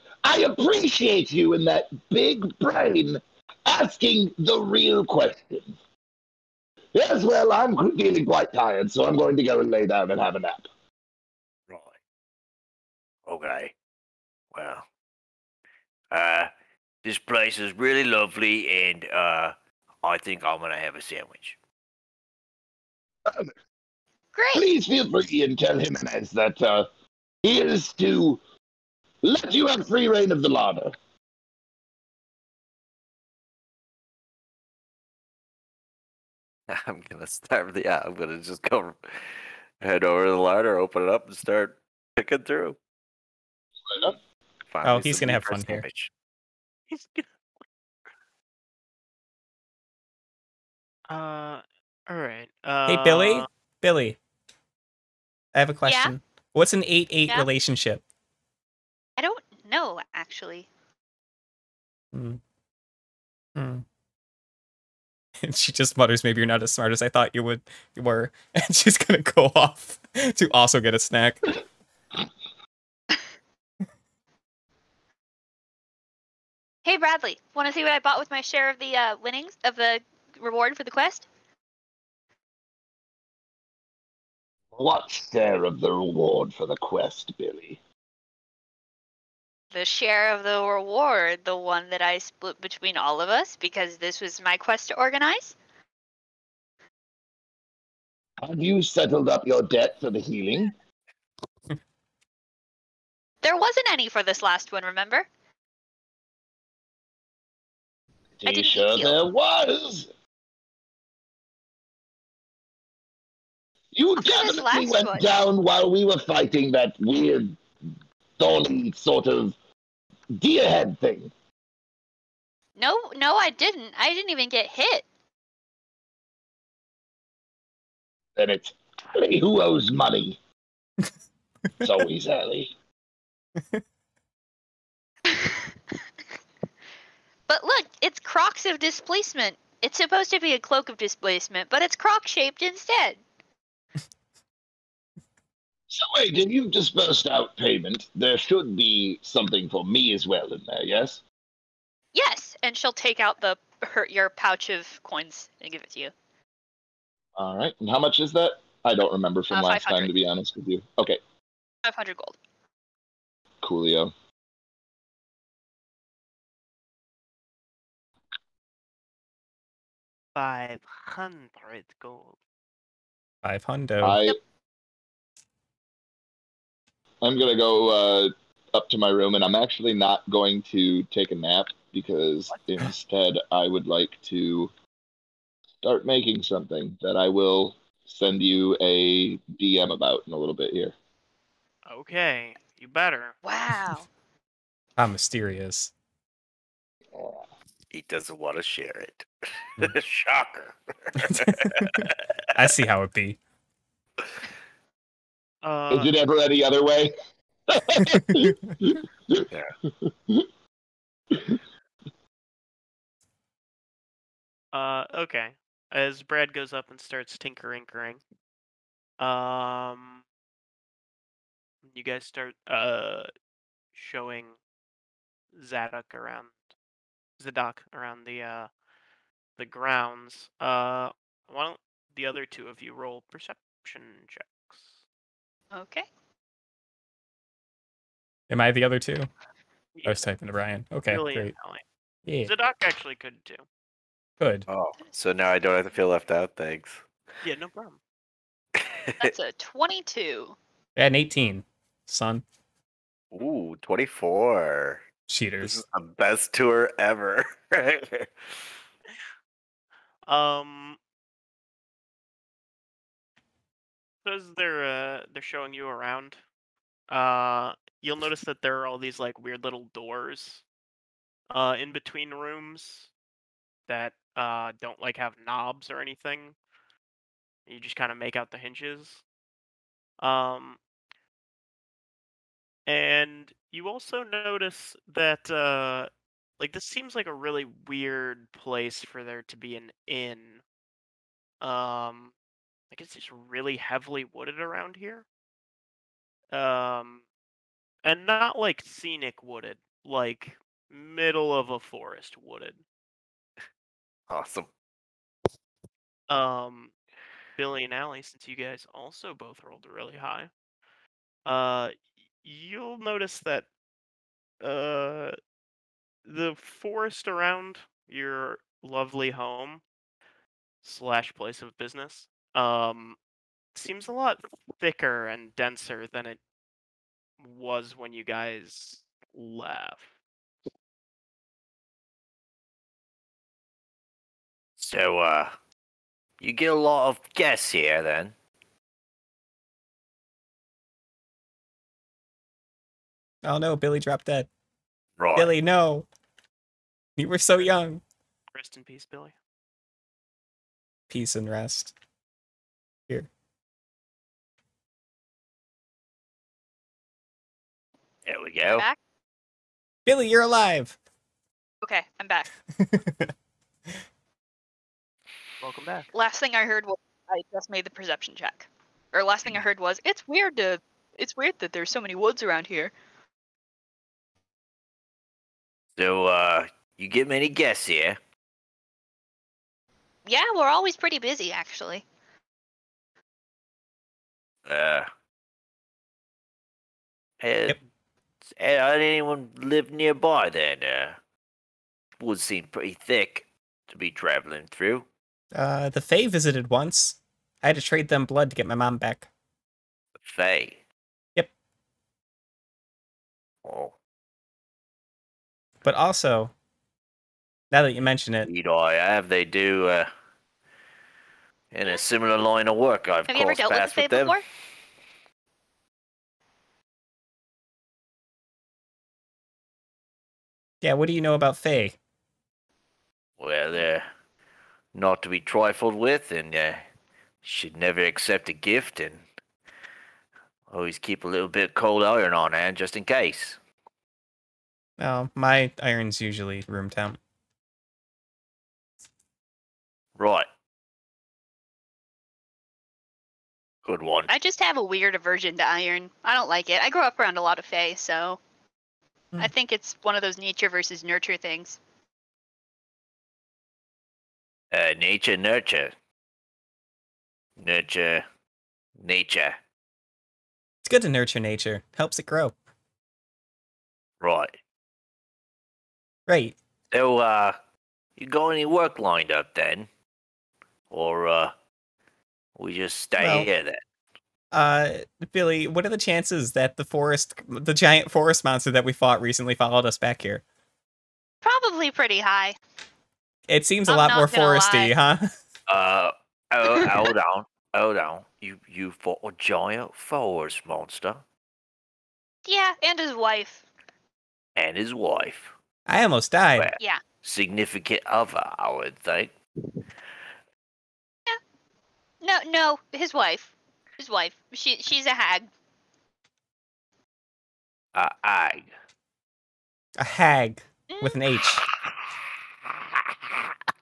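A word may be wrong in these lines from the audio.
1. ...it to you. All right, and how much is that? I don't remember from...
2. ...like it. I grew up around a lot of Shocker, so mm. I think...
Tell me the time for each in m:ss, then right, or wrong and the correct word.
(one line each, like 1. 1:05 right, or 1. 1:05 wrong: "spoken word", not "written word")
1. 2:35 right
2. 7:26 wrong: "Fae", not "Shocker".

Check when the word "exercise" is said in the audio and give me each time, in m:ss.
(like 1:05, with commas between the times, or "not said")
not said.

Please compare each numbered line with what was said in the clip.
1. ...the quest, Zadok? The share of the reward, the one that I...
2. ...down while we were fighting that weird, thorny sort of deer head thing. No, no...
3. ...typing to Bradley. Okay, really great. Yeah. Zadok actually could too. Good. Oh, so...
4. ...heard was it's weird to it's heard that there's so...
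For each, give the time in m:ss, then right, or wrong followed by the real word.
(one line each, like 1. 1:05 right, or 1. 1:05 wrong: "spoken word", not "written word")
1. 1:26 wrong: "Billie", not "Zadok"
2. 1:55 right
3. 4:00 wrong: "Brian", not "Bradley"
4. 6:09 wrong: "weird", not "heard".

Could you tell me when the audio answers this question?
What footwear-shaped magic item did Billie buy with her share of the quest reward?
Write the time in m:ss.
2:18.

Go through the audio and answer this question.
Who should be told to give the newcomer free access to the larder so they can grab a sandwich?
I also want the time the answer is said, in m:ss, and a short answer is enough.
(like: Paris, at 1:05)
Jimenez, at 0:25.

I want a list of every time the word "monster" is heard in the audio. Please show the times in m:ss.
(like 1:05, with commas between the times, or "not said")
7:58, 8:10.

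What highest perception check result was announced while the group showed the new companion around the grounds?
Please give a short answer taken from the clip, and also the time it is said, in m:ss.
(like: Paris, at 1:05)
24, at 4:13.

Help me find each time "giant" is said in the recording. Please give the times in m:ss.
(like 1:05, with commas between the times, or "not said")
7:57, 8:09.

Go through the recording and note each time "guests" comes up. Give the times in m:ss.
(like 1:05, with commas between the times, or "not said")
5:37, 6:17.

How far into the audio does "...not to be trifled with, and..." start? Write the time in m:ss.
7:04.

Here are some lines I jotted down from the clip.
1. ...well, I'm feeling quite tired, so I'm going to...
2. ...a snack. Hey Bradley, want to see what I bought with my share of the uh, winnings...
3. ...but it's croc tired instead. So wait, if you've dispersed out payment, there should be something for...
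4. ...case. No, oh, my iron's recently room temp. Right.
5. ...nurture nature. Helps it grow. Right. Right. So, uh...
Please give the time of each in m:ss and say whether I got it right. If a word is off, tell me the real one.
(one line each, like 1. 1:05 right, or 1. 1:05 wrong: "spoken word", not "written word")
1. 0:07 right
2. 1:10 right
3. 2:21 wrong: "shaped", not "tired"
4. 7:13 wrong: "usually", not "recently"
5. 7:41 right.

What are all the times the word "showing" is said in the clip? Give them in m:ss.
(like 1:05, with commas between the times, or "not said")
3:43, 4:25.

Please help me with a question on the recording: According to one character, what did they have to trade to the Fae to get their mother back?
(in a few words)
Blood.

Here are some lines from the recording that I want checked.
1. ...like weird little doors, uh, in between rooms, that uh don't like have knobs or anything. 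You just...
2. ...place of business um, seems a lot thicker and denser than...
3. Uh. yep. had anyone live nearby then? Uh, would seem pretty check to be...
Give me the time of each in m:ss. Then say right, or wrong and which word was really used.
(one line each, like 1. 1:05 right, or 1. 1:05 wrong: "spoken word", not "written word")
1. 4:29 right
2. 5:21 right
3. 6:24 wrong: "thick", not "check".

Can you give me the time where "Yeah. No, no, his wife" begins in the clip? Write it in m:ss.
8:19.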